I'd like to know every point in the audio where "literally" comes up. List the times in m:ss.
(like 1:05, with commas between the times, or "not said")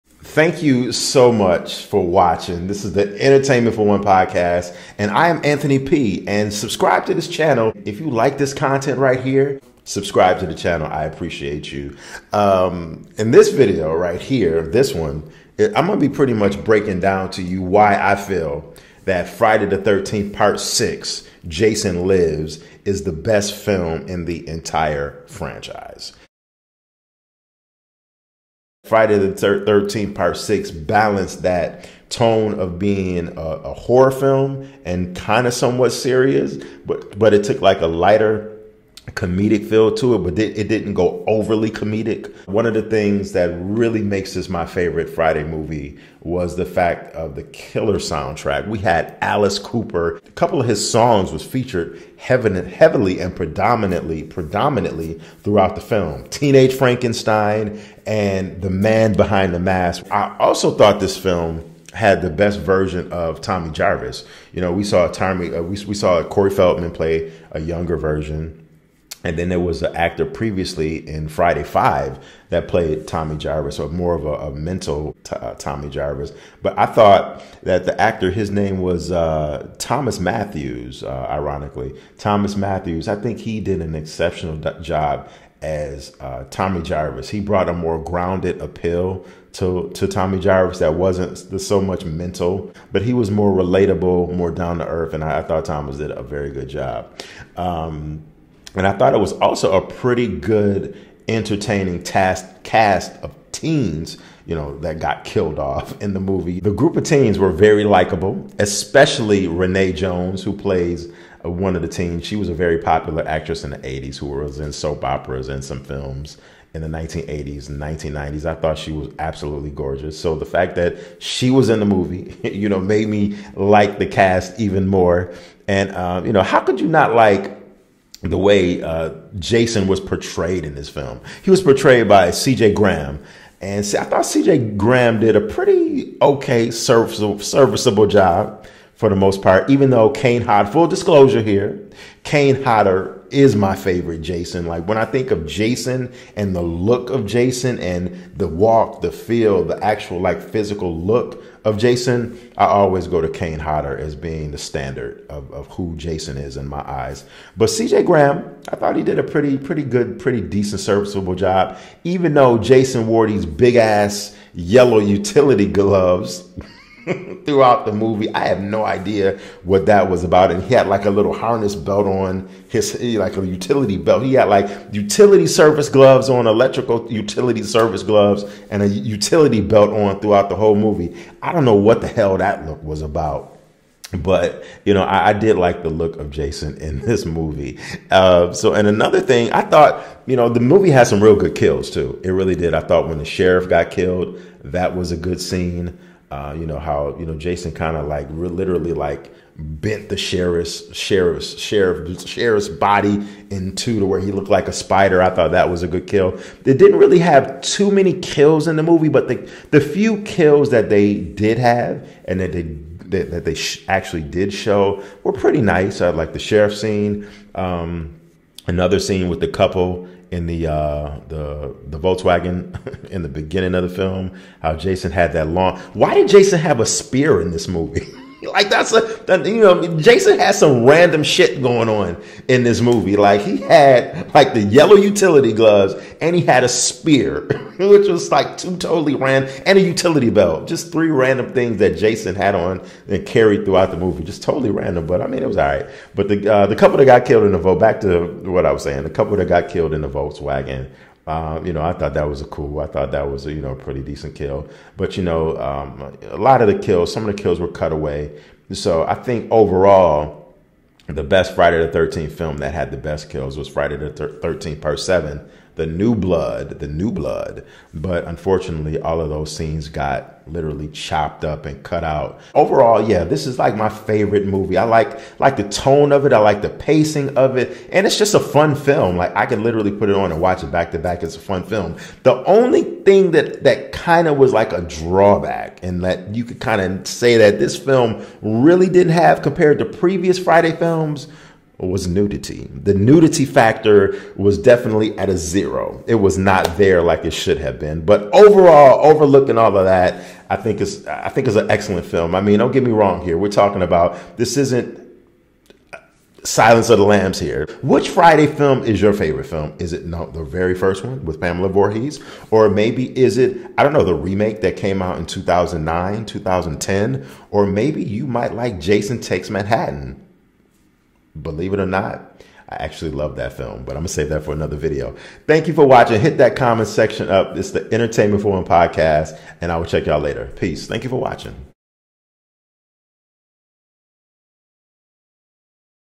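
3:18, 4:30, 4:39.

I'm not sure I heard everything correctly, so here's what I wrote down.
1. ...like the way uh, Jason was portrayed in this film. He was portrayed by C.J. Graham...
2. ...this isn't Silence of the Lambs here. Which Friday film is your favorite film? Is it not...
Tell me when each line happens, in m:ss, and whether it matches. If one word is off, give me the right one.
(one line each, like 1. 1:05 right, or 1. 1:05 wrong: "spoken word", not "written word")
1. 2:07 right
2. 5:04 right.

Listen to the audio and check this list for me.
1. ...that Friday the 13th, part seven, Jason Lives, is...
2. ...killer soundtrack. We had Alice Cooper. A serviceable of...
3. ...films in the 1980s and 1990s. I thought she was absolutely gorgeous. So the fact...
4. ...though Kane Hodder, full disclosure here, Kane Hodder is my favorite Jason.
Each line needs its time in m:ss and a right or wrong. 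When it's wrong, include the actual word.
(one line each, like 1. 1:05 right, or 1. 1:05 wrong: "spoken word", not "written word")
1. 0:19 wrong: "six", not "seven"
2. 0:47 wrong: "couple", not "serviceable"
3. 1:55 right
4. 2:19 right.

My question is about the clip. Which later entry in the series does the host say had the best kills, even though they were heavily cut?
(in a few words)
Friday the 13th Part 7, The New Blood.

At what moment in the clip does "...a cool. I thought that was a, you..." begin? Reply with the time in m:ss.
4:12.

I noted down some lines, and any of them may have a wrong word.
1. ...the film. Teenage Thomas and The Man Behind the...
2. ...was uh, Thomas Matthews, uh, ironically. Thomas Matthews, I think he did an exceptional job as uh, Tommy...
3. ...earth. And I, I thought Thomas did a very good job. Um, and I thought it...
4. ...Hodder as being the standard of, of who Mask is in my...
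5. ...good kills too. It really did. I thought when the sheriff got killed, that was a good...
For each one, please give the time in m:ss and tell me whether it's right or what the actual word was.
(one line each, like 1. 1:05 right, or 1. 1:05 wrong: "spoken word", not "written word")
1. 0:55 wrong: "Frankenstein", not "Thomas"
2. 1:18 right
3. 1:34 right
4. 2:33 wrong: "Jason", not "Mask"
5. 3:11 right.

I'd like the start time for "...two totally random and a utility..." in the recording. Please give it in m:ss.
3:58.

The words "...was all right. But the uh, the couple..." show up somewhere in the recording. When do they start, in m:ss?
4:05.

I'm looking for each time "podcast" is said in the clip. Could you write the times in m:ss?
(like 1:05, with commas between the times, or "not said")
0:04, 5:28.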